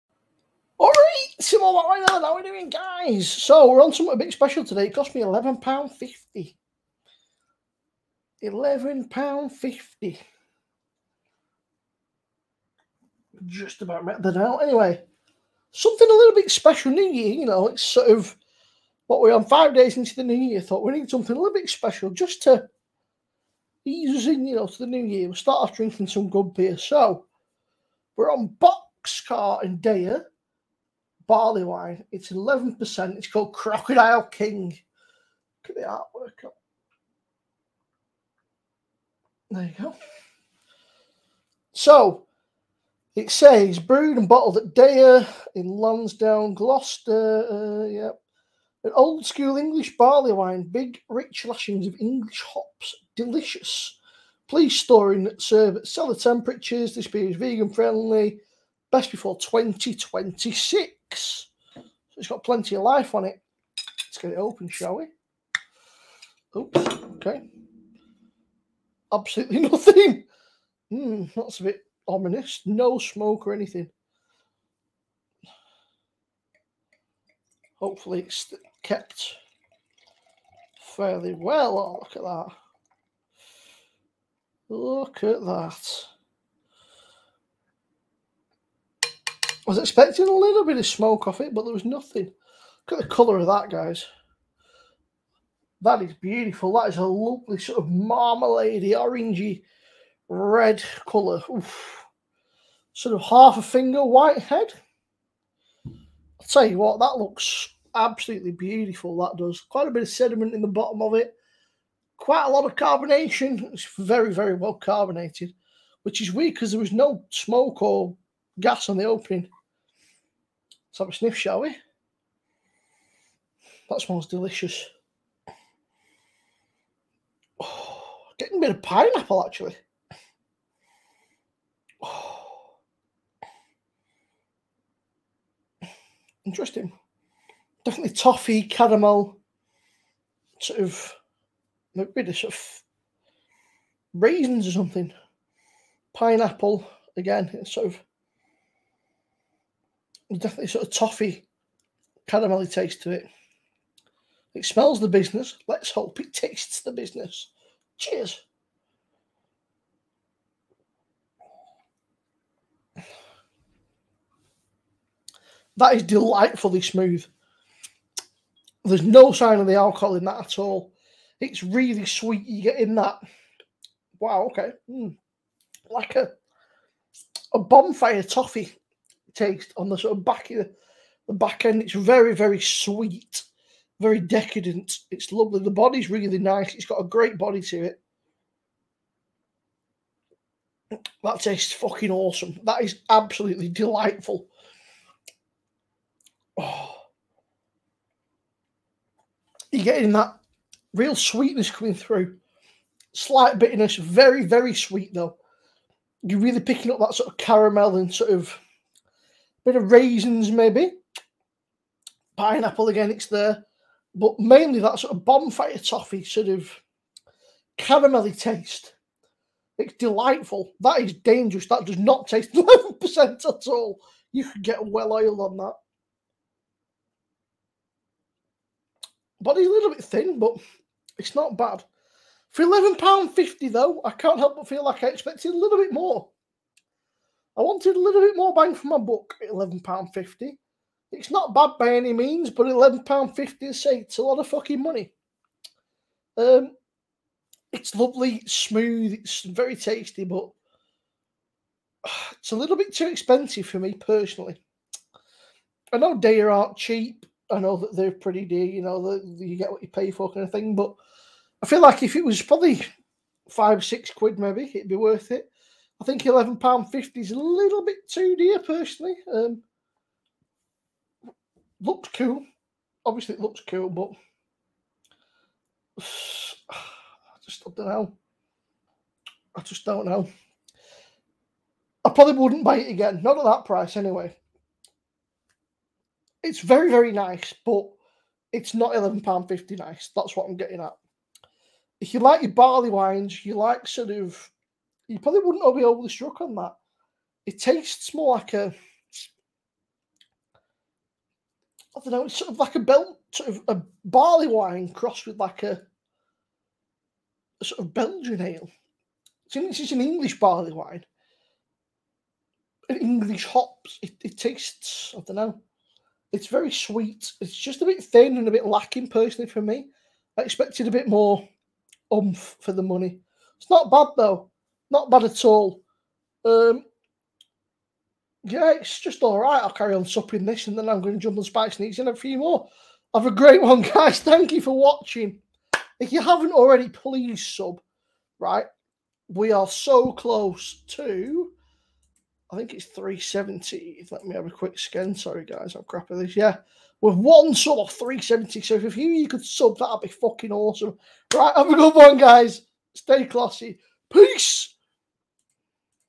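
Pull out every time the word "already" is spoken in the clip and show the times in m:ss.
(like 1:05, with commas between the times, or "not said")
5:36.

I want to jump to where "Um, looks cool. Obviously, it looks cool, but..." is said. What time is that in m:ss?
4:29.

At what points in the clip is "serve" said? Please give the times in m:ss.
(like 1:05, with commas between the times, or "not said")
0:55.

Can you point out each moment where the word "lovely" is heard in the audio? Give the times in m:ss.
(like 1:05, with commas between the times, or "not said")
1:37, 3:05, 4:07.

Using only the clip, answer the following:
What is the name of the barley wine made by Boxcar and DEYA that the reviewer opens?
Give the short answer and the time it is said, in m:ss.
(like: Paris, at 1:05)
Crocodile King, at 0:33.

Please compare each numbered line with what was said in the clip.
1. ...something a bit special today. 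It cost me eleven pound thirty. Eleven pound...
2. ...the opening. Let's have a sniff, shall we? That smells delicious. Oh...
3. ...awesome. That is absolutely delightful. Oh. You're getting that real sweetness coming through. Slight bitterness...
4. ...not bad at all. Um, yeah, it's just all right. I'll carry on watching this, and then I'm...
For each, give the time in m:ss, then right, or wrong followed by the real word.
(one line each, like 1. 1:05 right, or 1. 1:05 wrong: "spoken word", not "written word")
1. 0:03 wrong: "fifty", not "thirty"
2. 1:58 right
3. 3:12 right
4. 5:24 wrong: "supping", not "watching".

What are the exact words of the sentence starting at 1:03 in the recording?
Let's get it open, shall we?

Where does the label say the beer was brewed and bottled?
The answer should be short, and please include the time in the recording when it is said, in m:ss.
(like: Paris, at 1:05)
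Lansdown, Gloucester, at 0:45.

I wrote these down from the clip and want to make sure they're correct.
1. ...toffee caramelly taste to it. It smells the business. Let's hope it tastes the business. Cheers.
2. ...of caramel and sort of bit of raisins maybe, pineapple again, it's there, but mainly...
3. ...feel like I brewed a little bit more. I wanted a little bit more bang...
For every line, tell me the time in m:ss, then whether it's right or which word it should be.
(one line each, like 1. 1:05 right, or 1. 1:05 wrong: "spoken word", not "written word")
1. 2:30 right
2. 3:27 right
3. 3:54 wrong: "expected", not "brewed".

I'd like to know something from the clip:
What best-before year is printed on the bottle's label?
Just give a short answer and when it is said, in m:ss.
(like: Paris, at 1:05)
2026, at 0:59.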